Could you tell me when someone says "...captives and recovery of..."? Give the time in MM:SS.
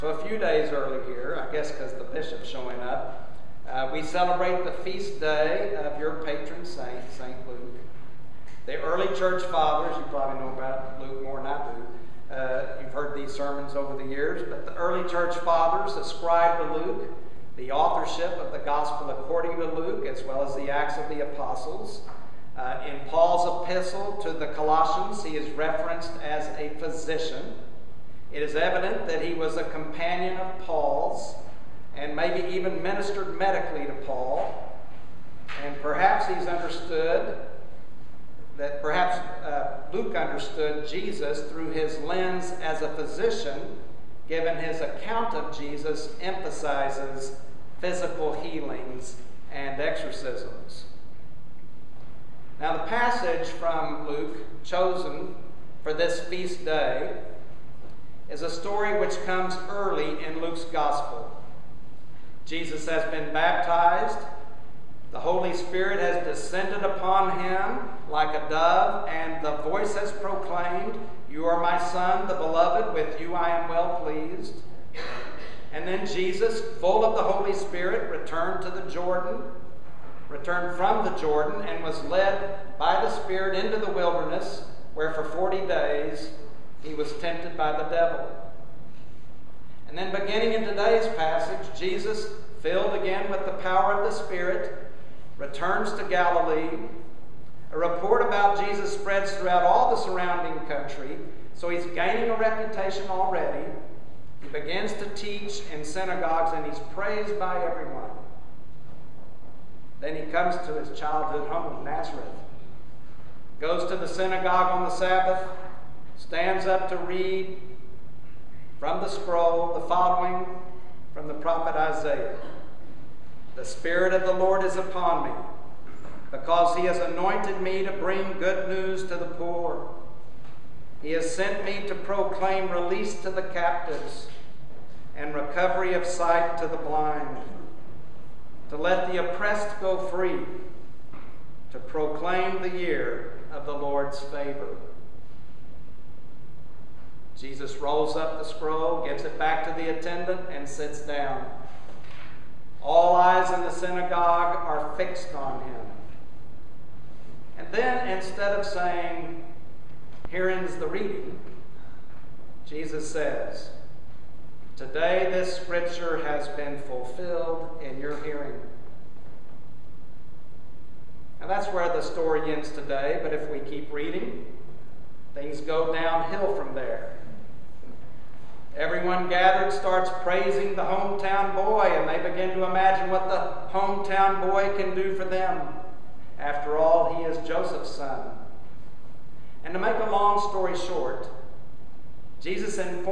02:13.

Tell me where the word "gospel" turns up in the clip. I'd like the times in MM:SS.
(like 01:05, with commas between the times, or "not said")
00:18, 01:00.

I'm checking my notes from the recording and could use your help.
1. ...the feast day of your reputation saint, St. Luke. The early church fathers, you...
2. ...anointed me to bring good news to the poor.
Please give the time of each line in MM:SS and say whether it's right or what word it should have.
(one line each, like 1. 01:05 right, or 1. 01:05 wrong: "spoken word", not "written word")
1. 00:04 wrong: "patron", not "reputation"
2. 02:06 right.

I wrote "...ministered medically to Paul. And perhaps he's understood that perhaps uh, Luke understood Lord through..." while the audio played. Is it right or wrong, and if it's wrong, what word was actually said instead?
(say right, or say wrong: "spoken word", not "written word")
wrong: "Jesus", not "Lord".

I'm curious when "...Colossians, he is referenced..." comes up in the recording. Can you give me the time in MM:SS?
00:24.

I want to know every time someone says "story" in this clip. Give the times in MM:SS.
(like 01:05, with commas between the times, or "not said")
00:58, 02:52, 03:10.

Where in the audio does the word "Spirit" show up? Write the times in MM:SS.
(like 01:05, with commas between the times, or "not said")
01:05, 01:17, 01:23, 01:34, 02:03.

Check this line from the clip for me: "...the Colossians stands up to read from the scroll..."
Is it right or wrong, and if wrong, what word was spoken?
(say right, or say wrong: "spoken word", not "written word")
wrong: "Sabbath", not "Colossians".